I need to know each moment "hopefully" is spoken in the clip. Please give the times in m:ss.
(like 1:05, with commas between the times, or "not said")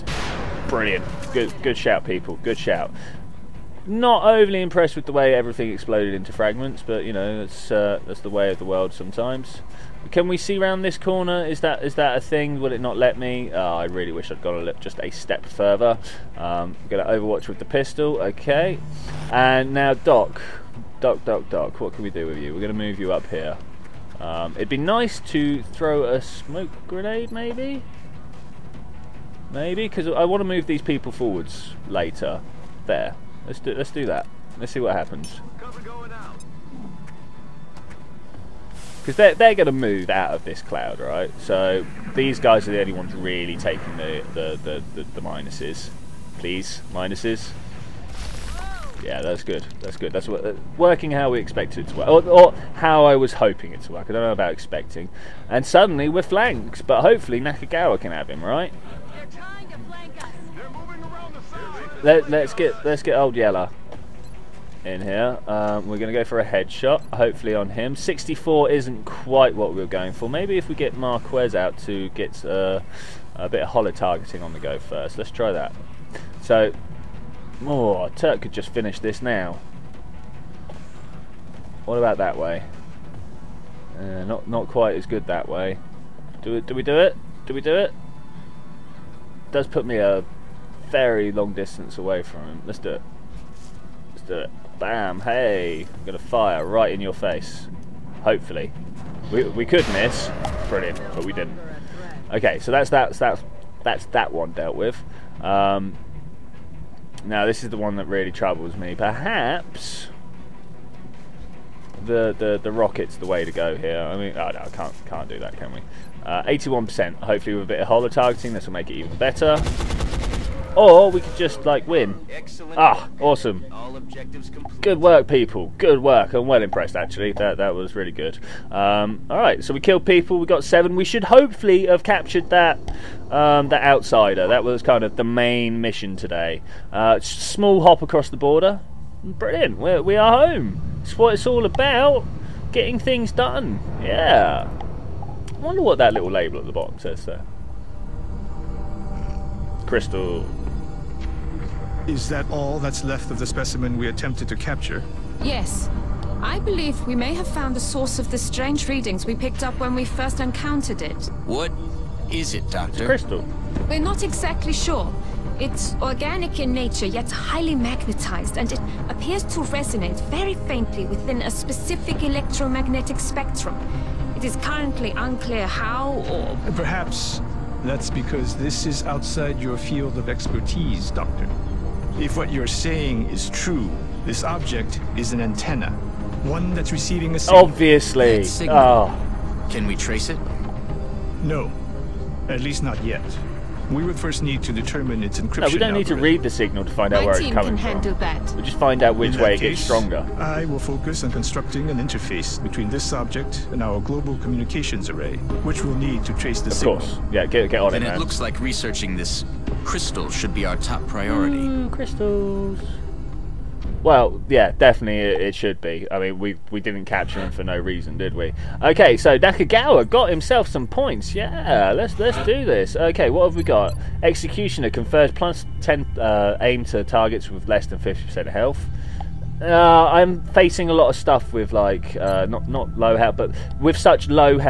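0:57, 1:07, 1:38, 1:57, 2:11.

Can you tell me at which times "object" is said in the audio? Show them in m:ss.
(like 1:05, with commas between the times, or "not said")
3:04, 3:23.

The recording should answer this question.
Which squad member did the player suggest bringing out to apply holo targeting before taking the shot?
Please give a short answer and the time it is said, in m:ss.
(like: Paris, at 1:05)
Marquez, at 1:10.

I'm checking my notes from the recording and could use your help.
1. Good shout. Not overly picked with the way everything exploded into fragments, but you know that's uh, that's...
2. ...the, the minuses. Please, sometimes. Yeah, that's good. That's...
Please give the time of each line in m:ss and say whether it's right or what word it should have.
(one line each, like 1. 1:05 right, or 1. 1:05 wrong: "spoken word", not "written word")
1. 0:02 wrong: "impressed", not "picked"
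2. 0:45 wrong: "minuses", not "sometimes".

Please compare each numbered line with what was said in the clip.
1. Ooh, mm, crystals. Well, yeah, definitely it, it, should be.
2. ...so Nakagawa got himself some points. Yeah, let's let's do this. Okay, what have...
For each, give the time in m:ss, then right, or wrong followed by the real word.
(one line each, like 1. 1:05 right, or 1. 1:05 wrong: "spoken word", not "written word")
1. 3:31 right
2. 3:39 right.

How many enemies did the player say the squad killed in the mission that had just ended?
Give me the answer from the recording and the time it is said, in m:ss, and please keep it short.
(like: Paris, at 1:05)
7, at 2:10.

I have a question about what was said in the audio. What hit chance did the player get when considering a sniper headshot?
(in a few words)
64.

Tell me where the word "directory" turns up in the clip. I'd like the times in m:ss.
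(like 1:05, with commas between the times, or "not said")
not said.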